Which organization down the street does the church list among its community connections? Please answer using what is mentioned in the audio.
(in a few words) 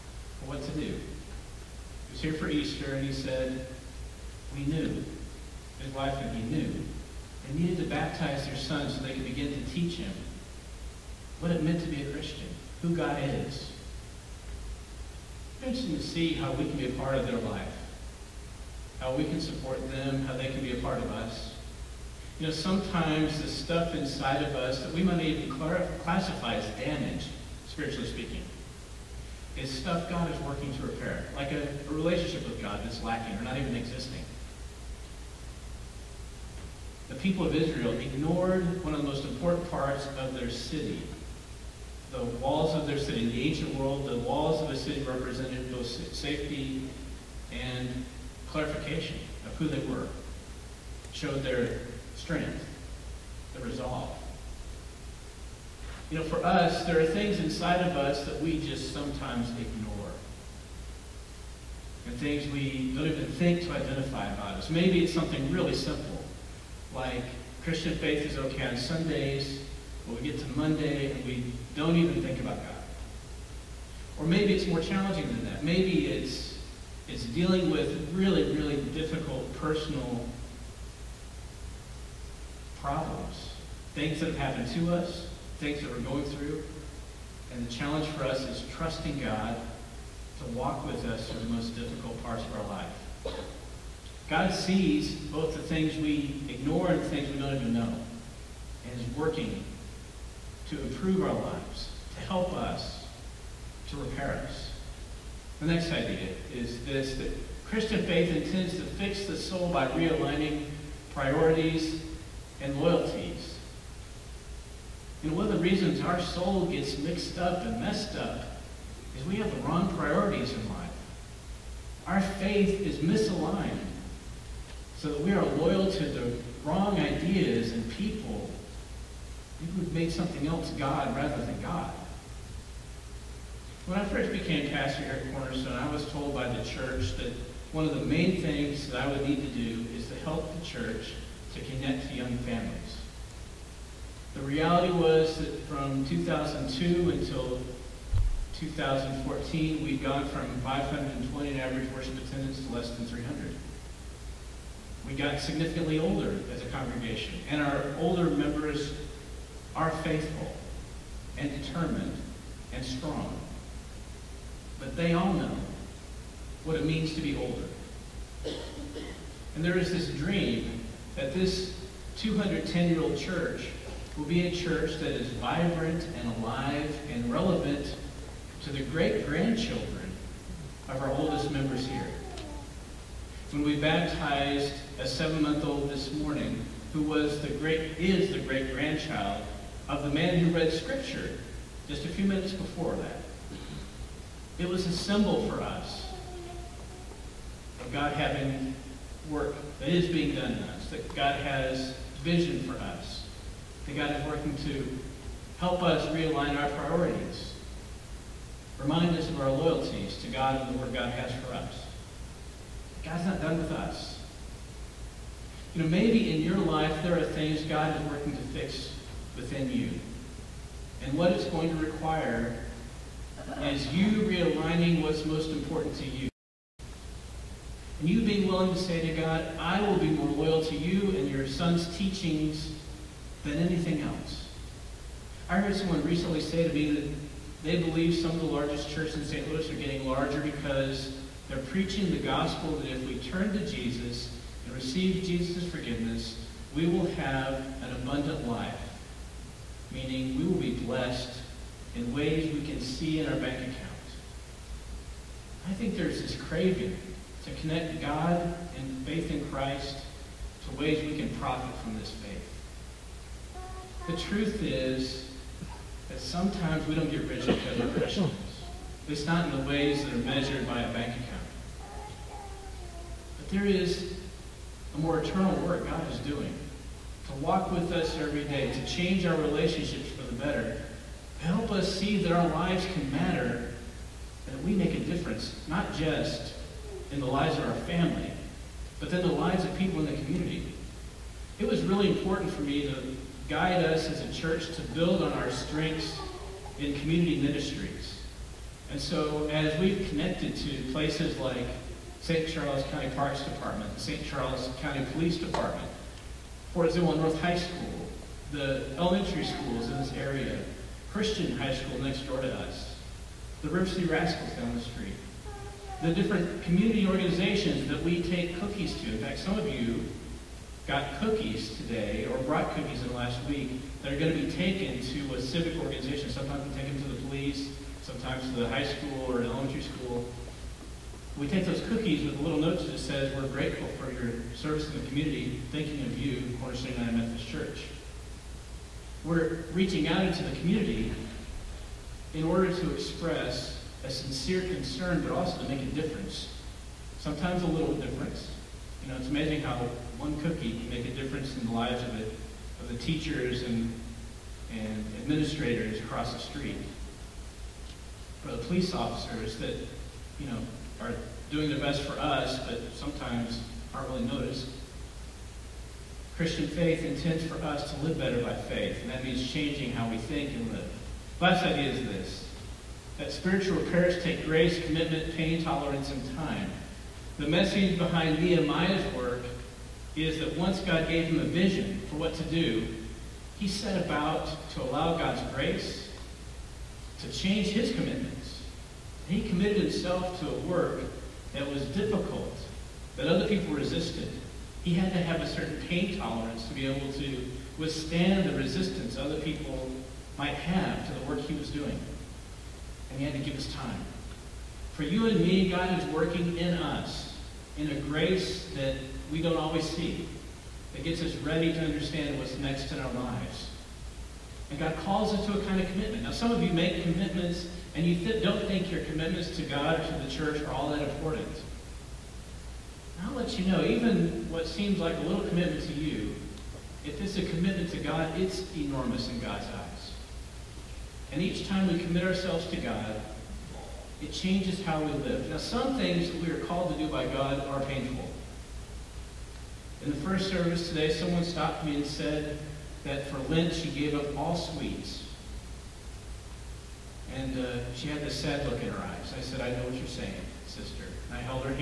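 River City Rascals.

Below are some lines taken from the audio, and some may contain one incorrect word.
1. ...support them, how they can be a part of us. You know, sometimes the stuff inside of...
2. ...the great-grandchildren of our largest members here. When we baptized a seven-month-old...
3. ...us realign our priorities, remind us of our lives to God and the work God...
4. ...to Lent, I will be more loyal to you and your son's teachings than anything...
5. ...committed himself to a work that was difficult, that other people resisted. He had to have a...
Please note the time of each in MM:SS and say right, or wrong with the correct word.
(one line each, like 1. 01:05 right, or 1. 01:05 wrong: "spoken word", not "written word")
1. 00:19 right
2. 02:58 wrong: "oldest", not "largest"
3. 03:25 wrong: "loyalties", not "lives"
4. 03:49 wrong: "God", not "Lent"
5. 06:29 right.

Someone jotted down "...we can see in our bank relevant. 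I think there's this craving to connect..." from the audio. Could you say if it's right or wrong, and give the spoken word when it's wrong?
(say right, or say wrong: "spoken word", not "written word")
wrong: "account", not "relevant".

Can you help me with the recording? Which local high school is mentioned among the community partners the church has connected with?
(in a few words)
Fort Zumwalt North High School.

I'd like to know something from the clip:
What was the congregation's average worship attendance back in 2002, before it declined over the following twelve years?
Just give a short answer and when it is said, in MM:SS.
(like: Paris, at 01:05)
520, at 02:30.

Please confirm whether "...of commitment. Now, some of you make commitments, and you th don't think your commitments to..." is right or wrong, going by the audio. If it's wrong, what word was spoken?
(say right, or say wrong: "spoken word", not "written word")
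right.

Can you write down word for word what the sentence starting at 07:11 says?
And each time we commit ourselves to God, it changes how we live.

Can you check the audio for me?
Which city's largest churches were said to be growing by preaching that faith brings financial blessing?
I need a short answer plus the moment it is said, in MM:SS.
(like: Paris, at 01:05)
St. Louis, at 03:59.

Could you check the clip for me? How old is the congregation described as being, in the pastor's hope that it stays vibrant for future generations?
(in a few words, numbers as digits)
210 years.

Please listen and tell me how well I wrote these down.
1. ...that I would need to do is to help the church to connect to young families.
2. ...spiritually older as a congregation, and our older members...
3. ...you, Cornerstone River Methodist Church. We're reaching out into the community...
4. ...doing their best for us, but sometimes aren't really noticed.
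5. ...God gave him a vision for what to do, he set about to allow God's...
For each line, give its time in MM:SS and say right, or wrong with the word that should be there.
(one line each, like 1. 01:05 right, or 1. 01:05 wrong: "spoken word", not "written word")
1. 02:18 right
2. 02:35 wrong: "significantly", not "spiritually"
3. 05:36 wrong: "United", not "River"
4. 06:01 right
5. 06:20 right.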